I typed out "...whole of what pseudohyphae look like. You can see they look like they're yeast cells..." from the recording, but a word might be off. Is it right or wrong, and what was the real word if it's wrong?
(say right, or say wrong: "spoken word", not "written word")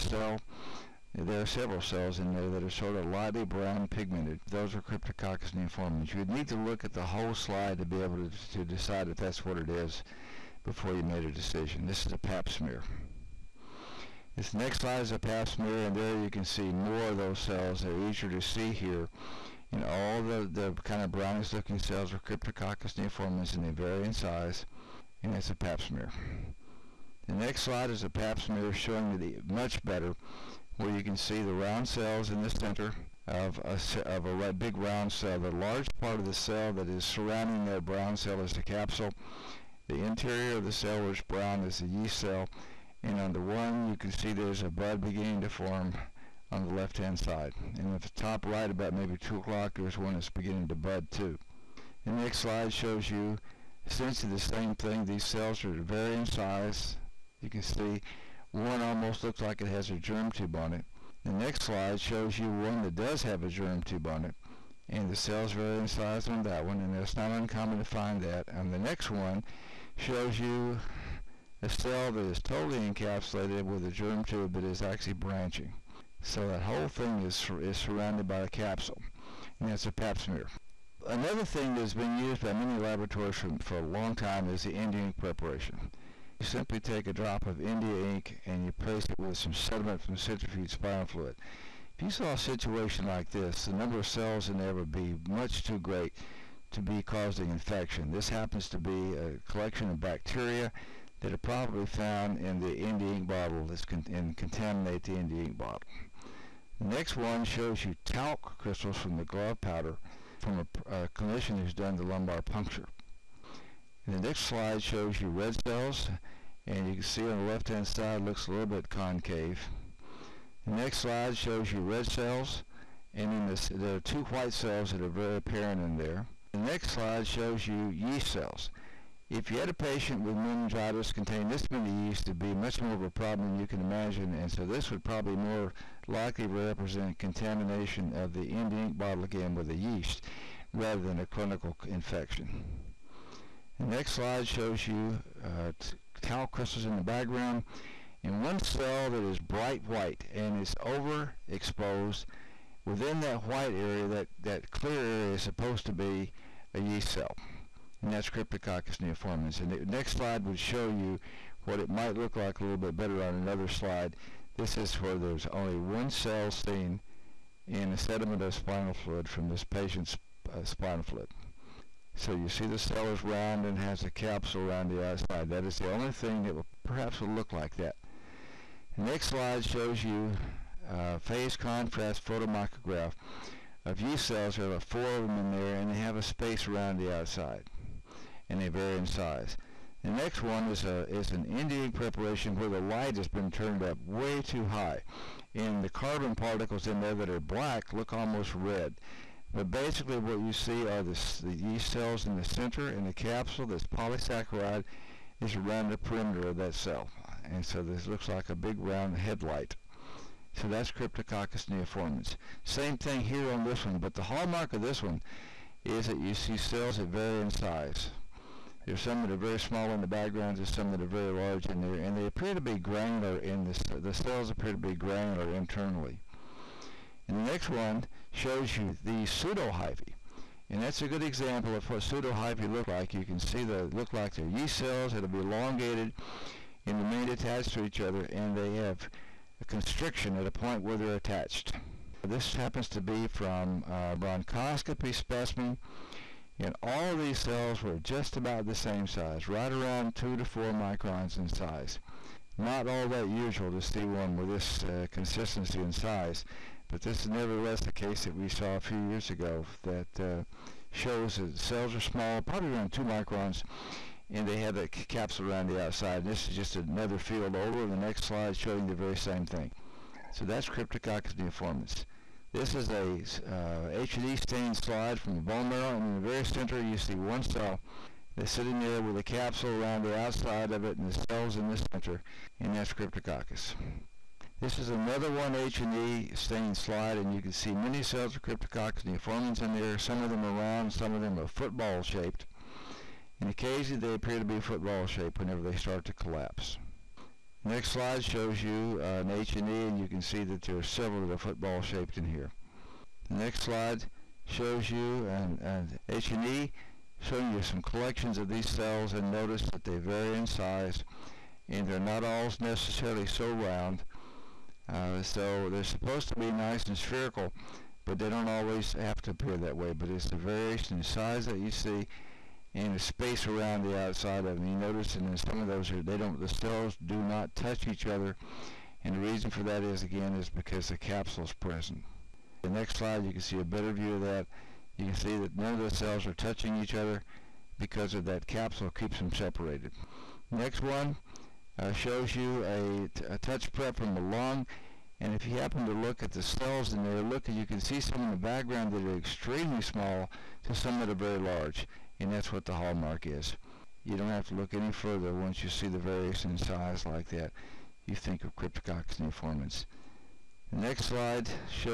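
wrong: "example", not "whole".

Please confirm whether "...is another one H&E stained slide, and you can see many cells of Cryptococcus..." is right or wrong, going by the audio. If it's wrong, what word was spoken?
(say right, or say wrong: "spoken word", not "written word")
right.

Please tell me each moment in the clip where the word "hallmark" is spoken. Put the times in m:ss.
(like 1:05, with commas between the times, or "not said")
3:34, 5:52.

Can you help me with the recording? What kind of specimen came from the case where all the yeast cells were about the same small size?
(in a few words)
bronchoscopy specimen.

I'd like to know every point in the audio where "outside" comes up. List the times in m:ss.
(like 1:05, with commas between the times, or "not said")
2:55, 3:07, 4:25, 4:40, 5:23.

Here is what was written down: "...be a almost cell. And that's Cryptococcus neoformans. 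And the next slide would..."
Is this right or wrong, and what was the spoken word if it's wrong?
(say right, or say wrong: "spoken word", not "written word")
wrong: "yeast", not "almost".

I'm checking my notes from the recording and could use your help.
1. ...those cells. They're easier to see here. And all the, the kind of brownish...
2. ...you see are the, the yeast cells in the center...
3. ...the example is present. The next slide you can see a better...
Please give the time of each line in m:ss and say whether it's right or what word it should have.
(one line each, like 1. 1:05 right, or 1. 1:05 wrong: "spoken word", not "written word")
1. 0:17 right
2. 3:20 right
3. 5:30 wrong: "capsule", not "example".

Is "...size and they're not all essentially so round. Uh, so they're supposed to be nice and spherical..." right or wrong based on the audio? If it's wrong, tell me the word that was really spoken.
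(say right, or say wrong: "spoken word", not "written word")
wrong: "necessarily", not "essentially".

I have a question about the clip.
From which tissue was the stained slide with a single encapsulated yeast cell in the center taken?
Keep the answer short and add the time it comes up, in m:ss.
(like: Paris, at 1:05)
bone marrow, at 4:35.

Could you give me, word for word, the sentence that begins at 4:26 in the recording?
This is just another field over.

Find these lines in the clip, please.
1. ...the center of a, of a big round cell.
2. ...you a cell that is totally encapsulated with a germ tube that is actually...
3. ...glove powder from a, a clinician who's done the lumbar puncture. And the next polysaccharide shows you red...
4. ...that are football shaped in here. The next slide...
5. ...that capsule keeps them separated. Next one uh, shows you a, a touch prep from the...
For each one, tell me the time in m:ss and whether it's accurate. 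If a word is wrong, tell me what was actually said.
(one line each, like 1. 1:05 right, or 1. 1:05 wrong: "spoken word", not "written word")
1. 0:32 right
2. 1:10 right
3. 1:49 wrong: "slide", not "polysaccharide"
4. 5:01 right
5. 5:38 right.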